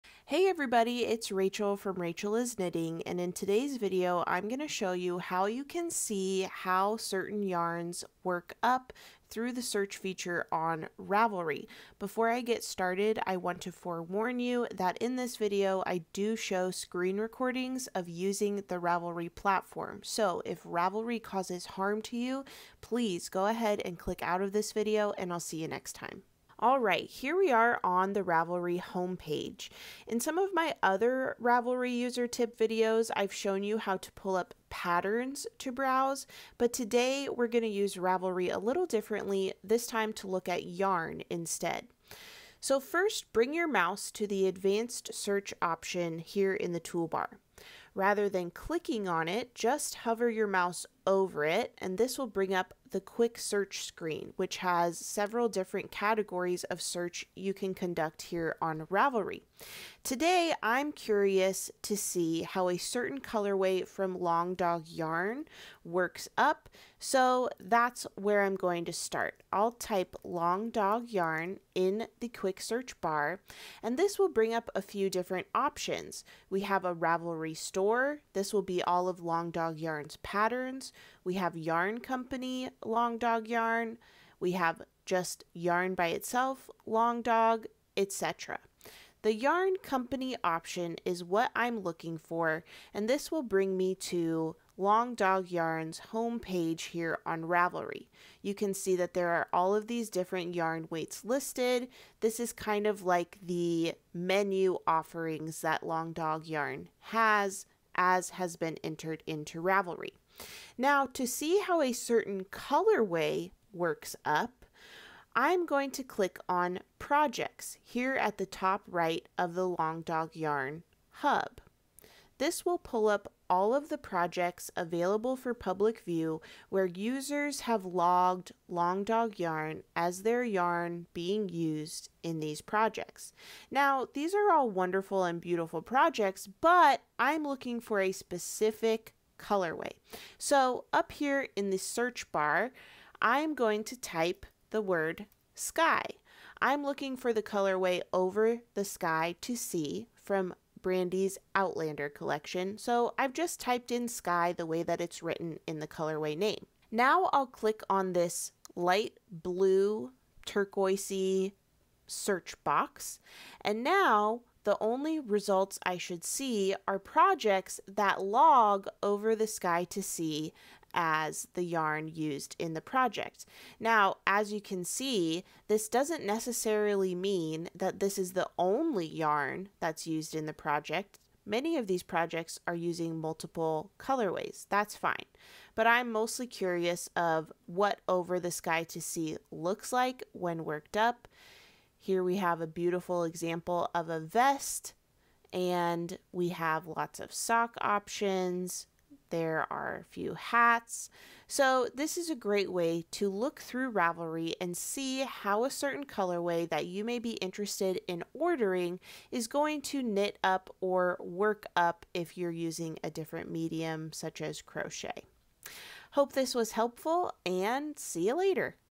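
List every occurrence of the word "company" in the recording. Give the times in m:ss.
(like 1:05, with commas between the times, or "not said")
1:21, 1:29.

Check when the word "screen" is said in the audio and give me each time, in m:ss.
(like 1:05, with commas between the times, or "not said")
0:16, 0:53.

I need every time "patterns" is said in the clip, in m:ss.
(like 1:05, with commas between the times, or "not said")
0:34, 1:20.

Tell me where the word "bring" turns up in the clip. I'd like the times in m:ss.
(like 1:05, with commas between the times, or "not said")
0:43, 0:52, 1:14, 1:33.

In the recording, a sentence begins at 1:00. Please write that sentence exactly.
Today, I'm curious to see how a certain colorway from Long Dog Yarn works up, so that's where I'm going to start.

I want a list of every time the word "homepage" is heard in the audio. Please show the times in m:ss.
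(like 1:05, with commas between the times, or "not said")
0:28, 1:36.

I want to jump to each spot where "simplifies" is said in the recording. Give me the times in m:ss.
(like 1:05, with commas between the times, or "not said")
not said.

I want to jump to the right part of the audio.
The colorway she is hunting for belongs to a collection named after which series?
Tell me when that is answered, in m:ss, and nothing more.
2:31.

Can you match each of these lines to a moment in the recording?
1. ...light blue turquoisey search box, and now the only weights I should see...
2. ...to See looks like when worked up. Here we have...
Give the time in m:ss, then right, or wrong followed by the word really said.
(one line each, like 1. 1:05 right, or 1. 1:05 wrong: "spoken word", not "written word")
1. 2:38 wrong: "results", not "weights"
2. 3:08 right.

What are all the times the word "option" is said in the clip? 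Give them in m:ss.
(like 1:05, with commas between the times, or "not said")
0:45, 1:15, 1:30, 3:17.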